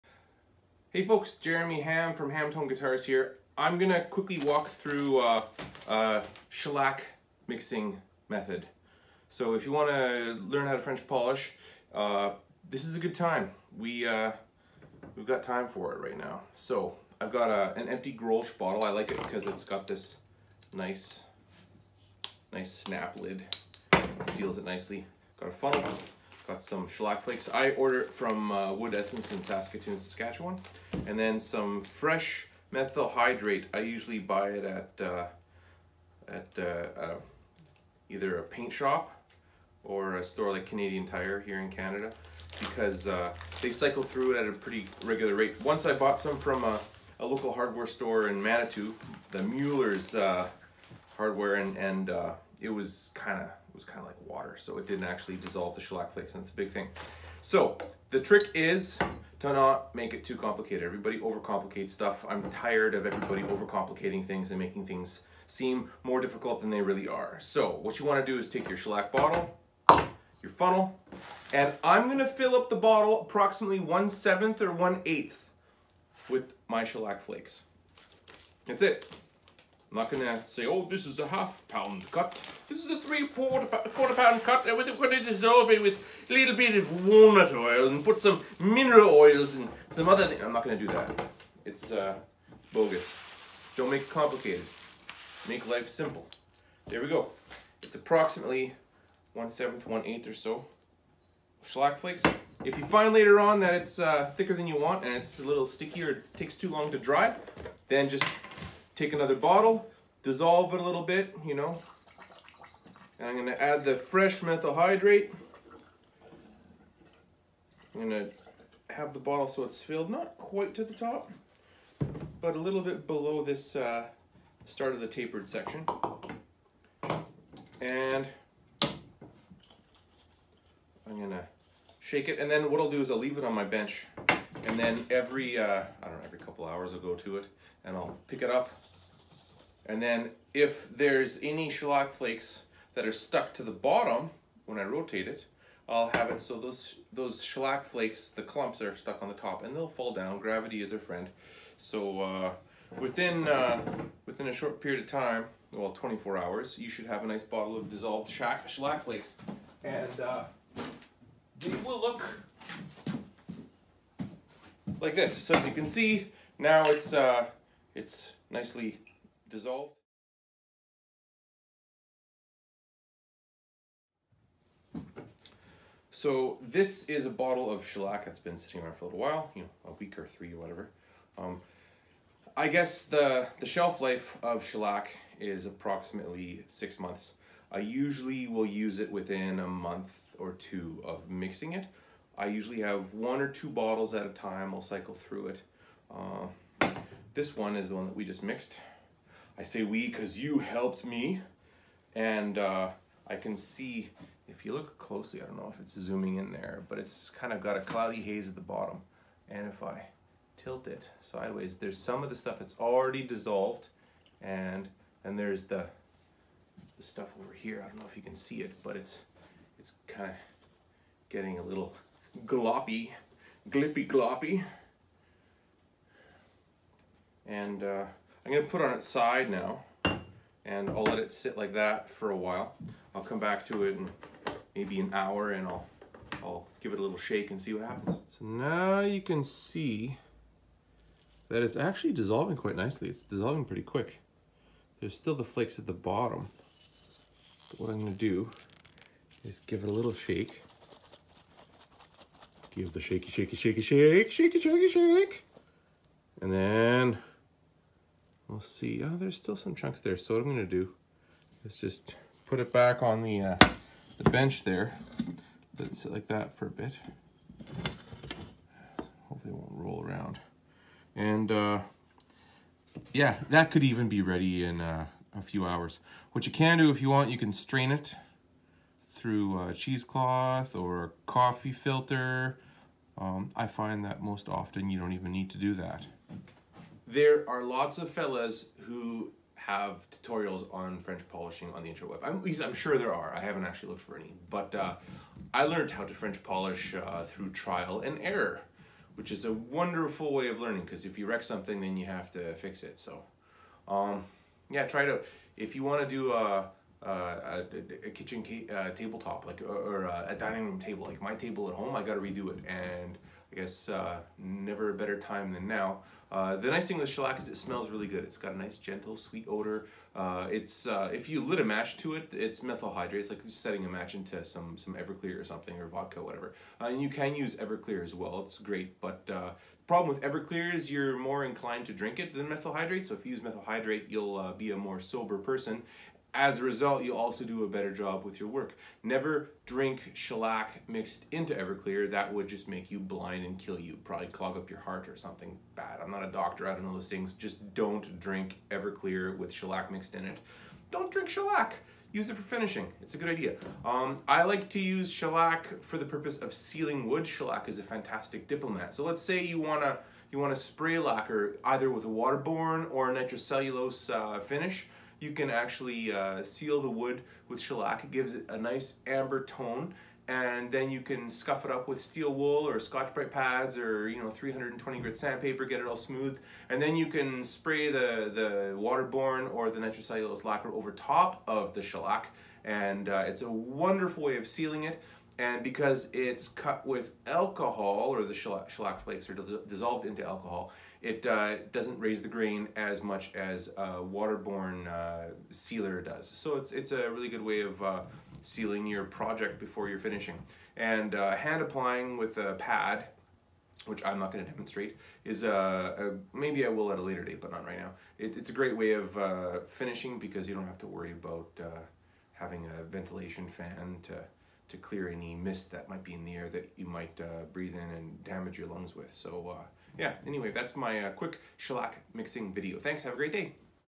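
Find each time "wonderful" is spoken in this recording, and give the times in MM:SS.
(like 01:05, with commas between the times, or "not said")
04:59, 06:23.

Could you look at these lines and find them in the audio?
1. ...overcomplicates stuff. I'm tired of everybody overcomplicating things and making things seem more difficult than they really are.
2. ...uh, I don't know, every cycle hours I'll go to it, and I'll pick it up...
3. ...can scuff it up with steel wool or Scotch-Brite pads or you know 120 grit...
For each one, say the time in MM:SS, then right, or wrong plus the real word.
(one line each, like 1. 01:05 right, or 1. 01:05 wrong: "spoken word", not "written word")
1. 01:01 right
2. 02:15 wrong: "couple", not "cycle"
3. 06:11 wrong: "320", not "120".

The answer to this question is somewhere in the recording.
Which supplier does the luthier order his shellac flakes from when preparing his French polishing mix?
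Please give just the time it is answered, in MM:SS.
00:28.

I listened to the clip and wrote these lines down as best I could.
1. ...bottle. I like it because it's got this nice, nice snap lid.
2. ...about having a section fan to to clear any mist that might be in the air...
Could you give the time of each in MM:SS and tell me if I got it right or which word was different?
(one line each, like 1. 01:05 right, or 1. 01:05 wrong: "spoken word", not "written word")
1. 00:18 right
2. 06:51 wrong: "ventilation", not "section".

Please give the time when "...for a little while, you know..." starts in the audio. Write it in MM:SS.
02:58.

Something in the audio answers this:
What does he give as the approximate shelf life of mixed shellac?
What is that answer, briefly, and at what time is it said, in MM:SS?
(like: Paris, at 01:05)
6 months, at 03:06.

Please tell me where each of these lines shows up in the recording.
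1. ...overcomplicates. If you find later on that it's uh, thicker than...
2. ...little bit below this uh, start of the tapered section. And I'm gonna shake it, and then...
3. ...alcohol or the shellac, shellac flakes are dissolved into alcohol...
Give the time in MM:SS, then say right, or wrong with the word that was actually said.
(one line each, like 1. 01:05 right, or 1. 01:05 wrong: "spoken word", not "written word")
1. 01:41 wrong: "flakes", not "overcomplicates"
2. 02:02 right
3. 06:27 right.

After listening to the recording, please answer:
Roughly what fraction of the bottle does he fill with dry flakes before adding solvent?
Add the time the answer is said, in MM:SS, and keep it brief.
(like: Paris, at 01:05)
1/7 or 1/8, at 01:13.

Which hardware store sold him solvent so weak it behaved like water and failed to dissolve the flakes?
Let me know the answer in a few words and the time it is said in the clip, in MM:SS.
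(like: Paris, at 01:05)
Mueller's, at 00:49.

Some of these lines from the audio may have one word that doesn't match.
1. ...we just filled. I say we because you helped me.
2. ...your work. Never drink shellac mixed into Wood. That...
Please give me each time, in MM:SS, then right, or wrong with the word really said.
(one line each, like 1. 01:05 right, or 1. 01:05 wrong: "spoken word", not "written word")
1. 03:18 wrong: "mixed", not "filled"
2. 05:38 wrong: "Everclear", not "Wood".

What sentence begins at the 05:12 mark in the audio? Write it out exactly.
And I guess uh, never a better time than now.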